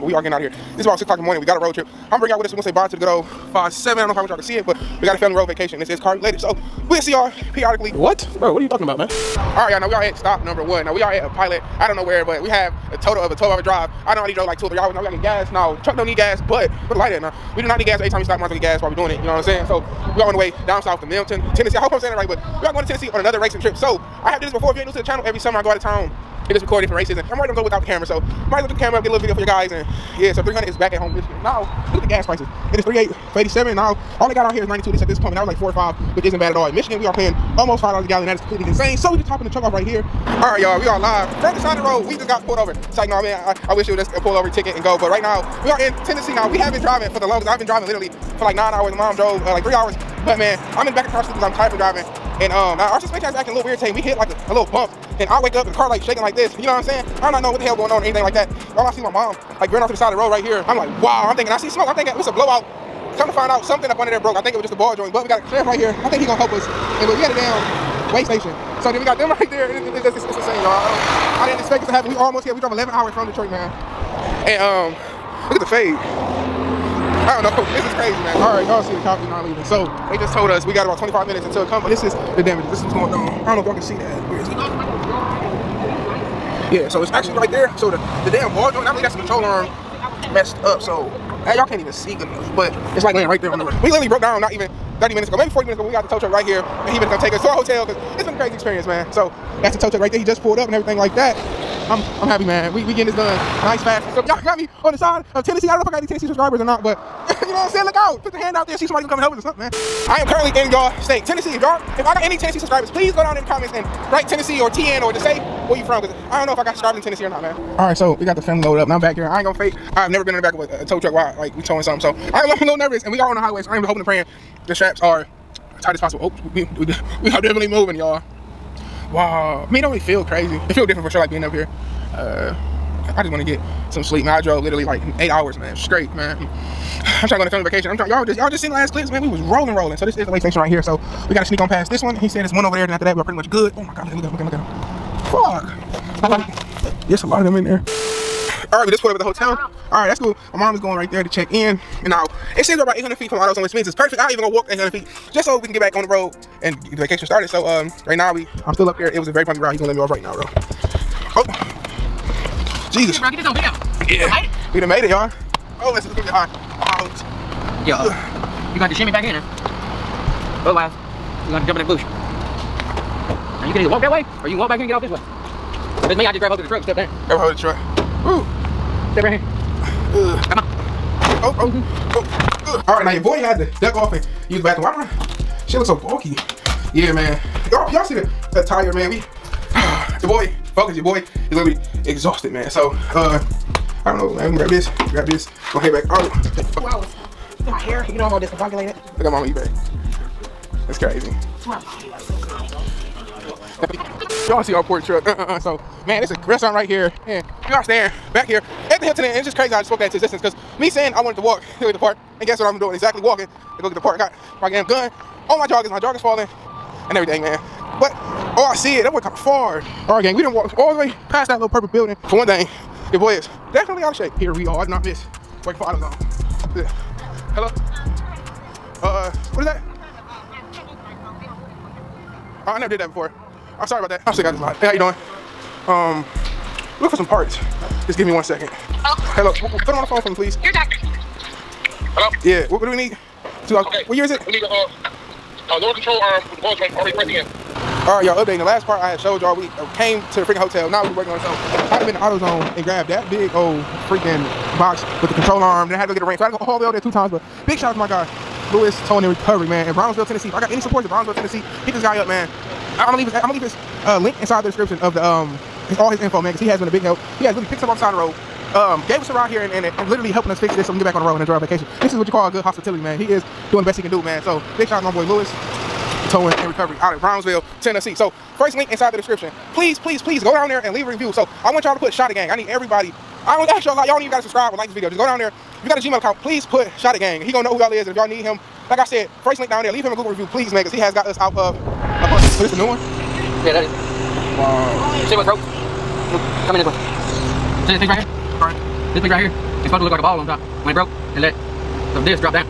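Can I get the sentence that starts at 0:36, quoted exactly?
In Michigan, we are paying almost five dollars a gallon.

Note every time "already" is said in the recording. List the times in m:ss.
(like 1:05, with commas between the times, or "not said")
0:14, 0:27, 4:06.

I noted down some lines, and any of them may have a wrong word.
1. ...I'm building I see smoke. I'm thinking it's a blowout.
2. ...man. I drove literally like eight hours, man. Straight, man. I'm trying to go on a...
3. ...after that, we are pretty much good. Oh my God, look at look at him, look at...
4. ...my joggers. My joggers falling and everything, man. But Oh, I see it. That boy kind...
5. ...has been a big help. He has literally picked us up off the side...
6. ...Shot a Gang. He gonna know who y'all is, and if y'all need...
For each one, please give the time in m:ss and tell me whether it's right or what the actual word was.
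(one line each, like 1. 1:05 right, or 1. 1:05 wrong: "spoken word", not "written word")
1. 1:01 wrong: "thinking", not "building"
2. 2:14 right
3. 2:22 right
4. 3:35 right
5. 4:26 right
6. 4:46 right.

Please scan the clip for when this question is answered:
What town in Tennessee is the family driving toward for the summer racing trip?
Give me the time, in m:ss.
0:21.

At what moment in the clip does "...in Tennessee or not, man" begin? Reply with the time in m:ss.
1:56.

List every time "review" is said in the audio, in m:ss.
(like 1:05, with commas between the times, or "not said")
4:41, 4:50.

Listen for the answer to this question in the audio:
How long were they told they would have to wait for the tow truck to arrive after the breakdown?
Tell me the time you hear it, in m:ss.
1:20.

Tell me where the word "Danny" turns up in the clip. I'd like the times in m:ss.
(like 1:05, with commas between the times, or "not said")
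not said.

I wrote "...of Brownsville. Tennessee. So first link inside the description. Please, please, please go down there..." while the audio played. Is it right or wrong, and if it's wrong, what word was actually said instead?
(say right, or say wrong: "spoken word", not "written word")
right.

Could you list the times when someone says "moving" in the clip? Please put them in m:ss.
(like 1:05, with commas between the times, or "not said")
2:07.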